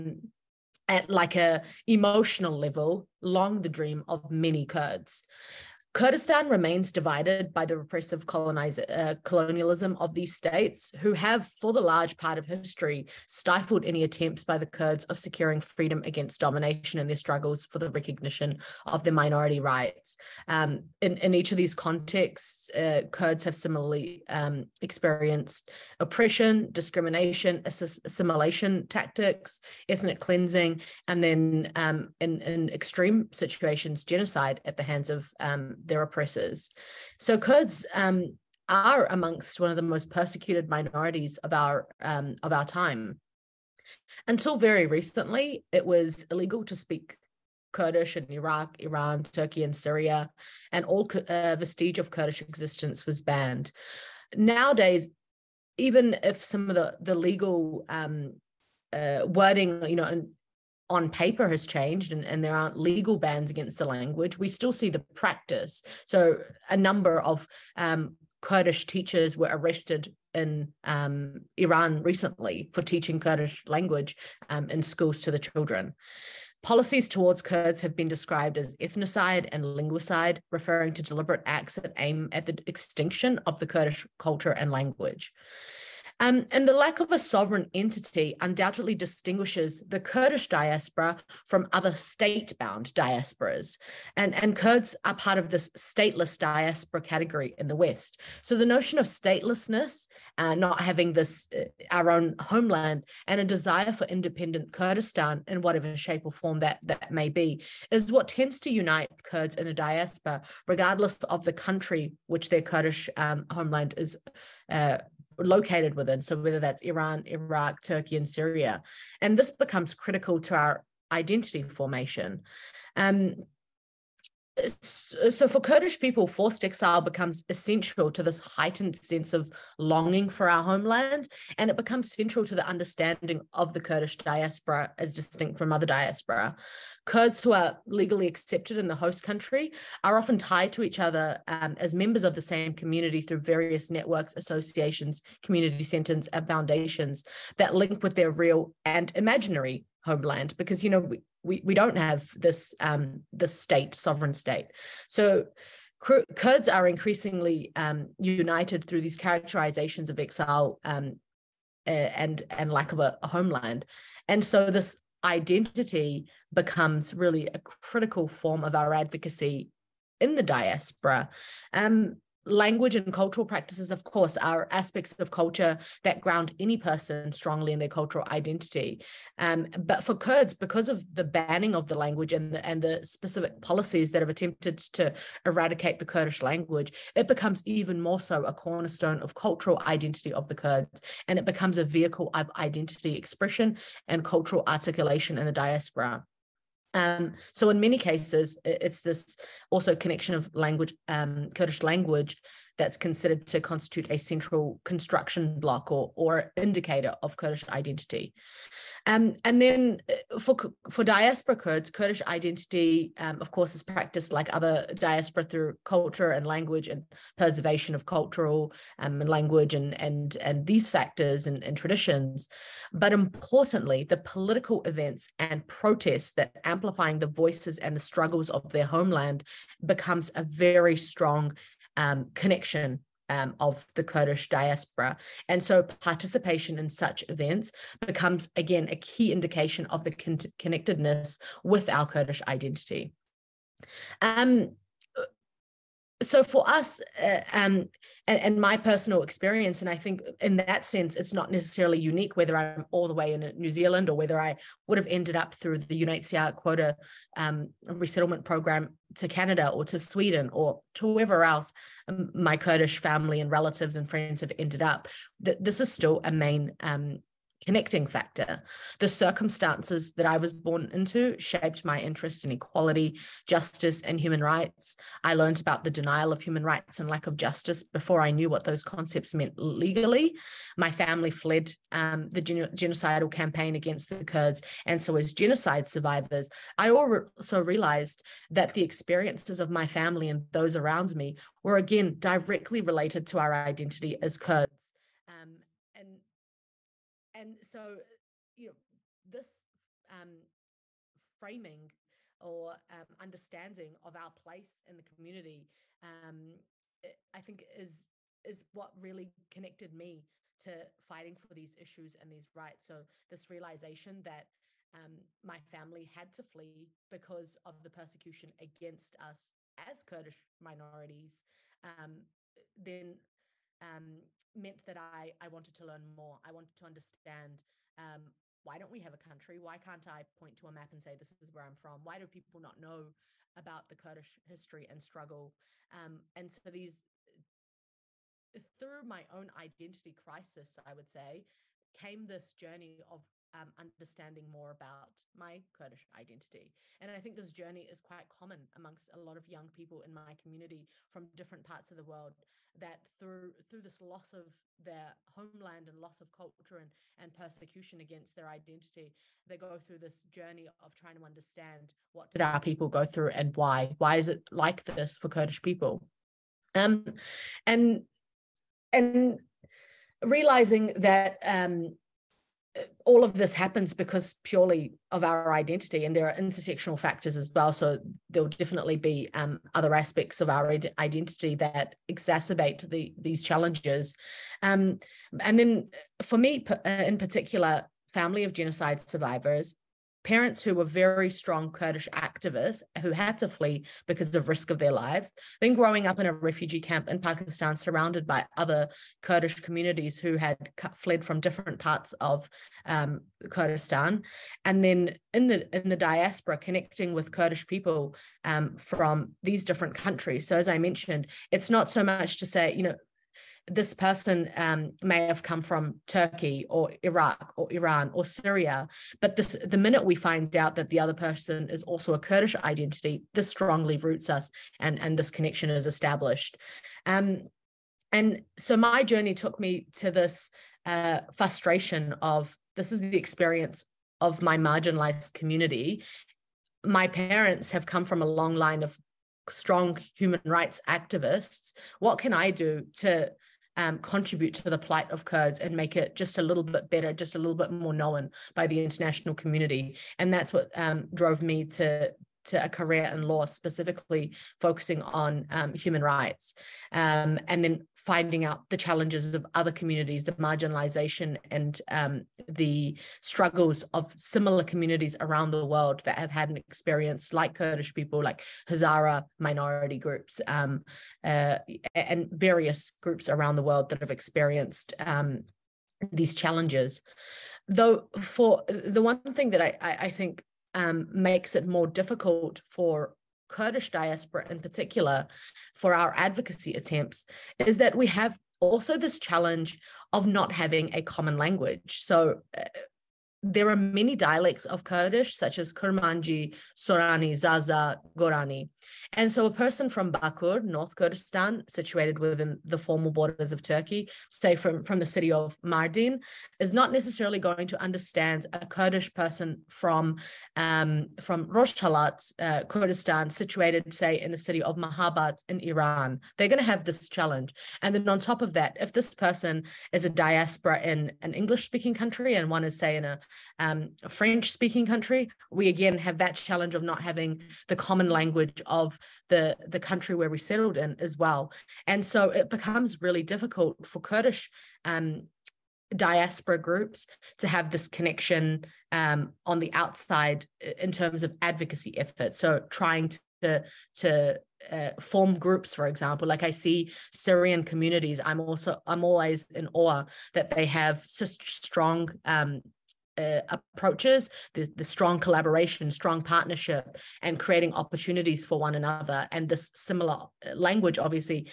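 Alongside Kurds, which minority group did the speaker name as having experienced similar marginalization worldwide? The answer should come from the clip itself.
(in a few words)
Hazara.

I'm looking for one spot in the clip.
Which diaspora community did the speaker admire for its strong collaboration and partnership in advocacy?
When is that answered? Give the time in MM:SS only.
09:07.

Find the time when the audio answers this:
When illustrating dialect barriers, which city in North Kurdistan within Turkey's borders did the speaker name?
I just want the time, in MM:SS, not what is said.
08:25.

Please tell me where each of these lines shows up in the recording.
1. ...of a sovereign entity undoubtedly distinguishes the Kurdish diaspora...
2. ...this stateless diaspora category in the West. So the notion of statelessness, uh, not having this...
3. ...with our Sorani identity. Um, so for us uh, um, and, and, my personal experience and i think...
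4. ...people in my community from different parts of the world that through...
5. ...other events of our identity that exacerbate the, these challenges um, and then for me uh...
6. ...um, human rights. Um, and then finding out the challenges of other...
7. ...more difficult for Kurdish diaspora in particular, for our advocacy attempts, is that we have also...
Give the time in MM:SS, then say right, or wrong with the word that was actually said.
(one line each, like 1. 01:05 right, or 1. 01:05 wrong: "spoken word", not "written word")
1. 01:27 right
2. 01:35 right
3. 04:01 wrong: "Kurdish", not "Sorani"
4. 05:49 right
5. 06:19 wrong: "aspects", not "events"
6. 07:35 right
7. 08:01 right.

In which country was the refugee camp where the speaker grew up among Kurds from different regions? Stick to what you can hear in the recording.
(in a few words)
Pakistan.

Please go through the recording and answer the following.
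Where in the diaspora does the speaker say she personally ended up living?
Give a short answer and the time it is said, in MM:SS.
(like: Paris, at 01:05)
New Zealand, at 04:13.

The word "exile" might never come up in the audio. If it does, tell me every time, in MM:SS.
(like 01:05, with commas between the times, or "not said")
02:06, 02:40.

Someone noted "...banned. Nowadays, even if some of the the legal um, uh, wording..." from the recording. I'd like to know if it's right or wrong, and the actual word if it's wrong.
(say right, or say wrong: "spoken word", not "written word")
right.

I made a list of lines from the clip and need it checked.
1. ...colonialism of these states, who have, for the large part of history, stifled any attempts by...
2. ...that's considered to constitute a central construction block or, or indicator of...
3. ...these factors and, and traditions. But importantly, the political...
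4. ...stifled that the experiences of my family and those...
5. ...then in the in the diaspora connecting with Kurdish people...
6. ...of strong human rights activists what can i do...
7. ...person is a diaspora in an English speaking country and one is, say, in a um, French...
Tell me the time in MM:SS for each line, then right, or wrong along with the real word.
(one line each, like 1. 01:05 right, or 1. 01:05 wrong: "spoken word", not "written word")
1. 00:09 right
2. 03:22 right
3. 03:40 right
4. 04:47 wrong: "realized", not "stifled"
5. 06:44 right
6. 07:18 right
7. 08:39 right.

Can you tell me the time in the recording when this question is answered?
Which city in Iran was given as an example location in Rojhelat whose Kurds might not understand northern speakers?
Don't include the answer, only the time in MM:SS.
08:34.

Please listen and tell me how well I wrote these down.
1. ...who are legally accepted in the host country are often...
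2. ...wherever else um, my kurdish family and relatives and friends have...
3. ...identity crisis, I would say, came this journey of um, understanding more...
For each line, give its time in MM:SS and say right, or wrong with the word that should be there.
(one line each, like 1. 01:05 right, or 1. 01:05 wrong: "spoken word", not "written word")
1. 02:17 right
2. 04:21 right
3. 05:39 right.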